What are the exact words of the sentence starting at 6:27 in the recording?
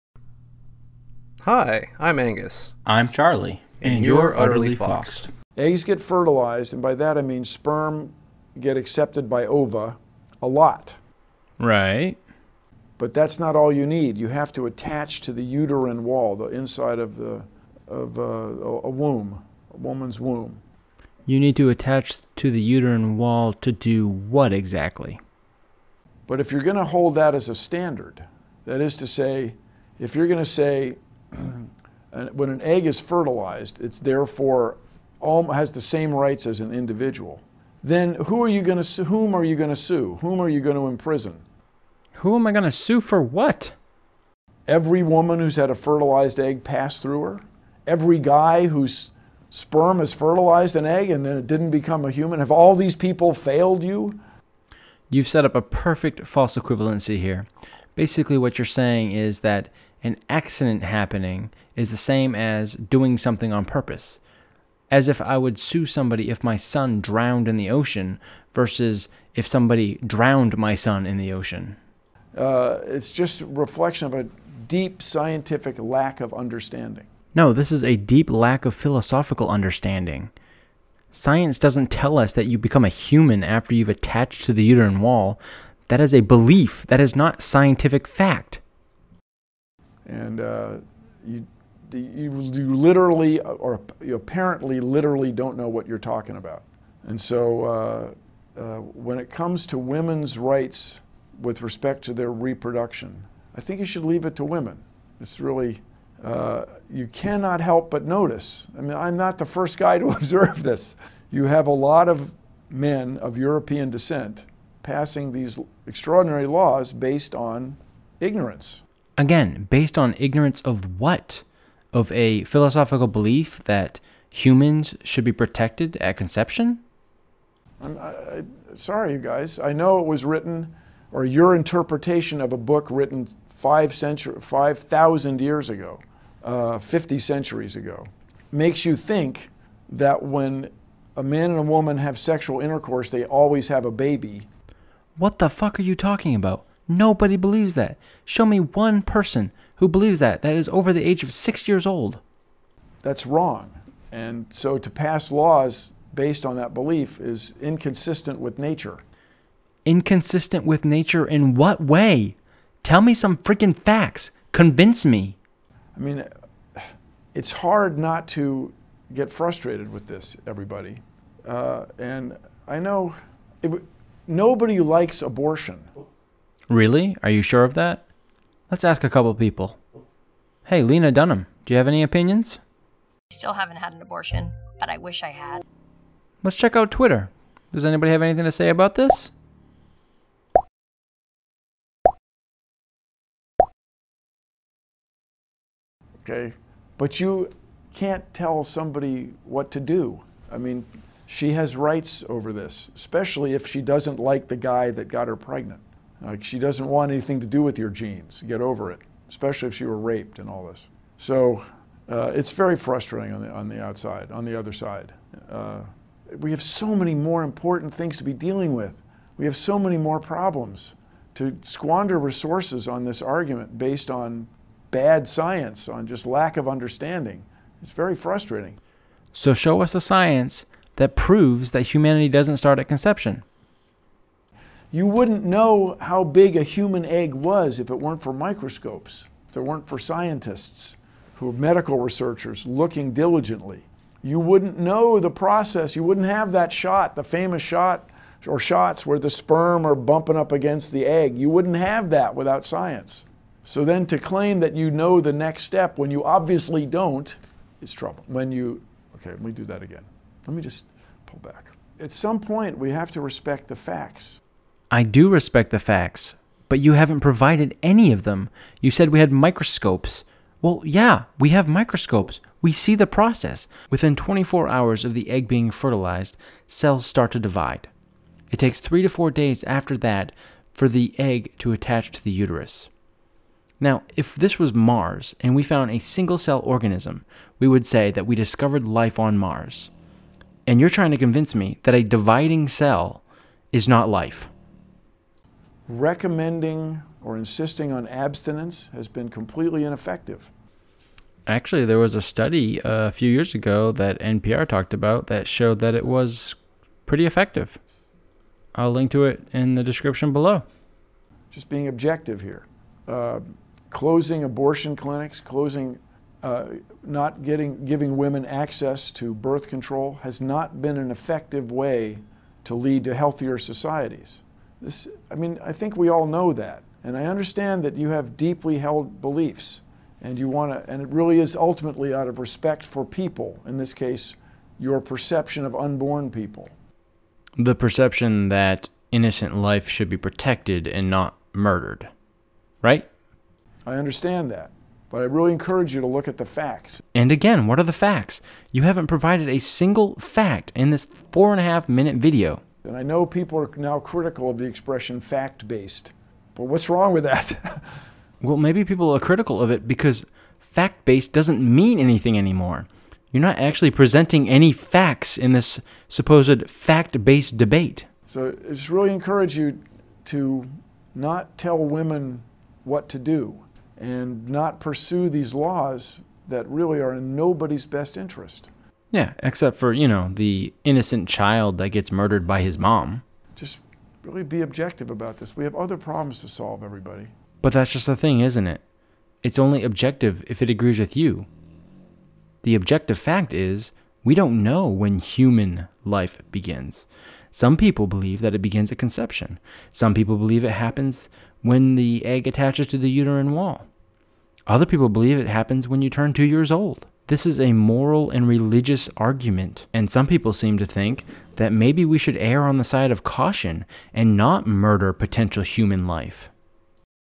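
But that's just the thing, isn't it?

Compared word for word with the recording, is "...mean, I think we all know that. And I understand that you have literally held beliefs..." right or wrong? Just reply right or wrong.
wrong.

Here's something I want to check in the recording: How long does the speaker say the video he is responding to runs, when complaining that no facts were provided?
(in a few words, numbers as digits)
4.5 minutes.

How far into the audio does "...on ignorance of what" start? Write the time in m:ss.
1:59.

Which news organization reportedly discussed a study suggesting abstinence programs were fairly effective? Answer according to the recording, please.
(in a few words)
NPR.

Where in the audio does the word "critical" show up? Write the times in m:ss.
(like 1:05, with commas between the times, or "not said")
5:53, 5:59.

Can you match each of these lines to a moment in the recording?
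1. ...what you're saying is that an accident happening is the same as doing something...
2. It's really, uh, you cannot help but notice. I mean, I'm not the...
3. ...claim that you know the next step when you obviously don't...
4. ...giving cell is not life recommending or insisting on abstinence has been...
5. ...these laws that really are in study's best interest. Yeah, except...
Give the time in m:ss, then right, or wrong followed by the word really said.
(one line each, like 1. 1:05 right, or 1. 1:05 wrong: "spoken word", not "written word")
1. 0:58 right
2. 1:45 right
3. 4:14 right
4. 4:52 wrong: "dividing", not "giving"
5. 6:15 wrong: "nobody", not "study".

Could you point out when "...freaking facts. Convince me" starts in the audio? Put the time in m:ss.
2:43.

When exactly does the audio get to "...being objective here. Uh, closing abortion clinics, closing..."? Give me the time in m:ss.
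5:11.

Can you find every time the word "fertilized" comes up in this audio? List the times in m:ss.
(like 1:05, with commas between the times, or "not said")
0:05, 0:32, 0:45, 0:50, 4:35.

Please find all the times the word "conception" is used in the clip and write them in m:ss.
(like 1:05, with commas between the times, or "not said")
2:06, 3:52, 6:38.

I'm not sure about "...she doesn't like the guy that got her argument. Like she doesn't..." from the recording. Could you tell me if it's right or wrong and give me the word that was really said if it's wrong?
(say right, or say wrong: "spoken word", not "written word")
wrong: "pregnant", not "argument".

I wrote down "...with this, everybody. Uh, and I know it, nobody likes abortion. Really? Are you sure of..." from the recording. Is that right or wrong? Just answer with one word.
right.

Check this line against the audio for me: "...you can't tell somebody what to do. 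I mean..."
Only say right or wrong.
right.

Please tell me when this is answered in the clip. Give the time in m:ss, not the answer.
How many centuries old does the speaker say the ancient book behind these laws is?
2:16.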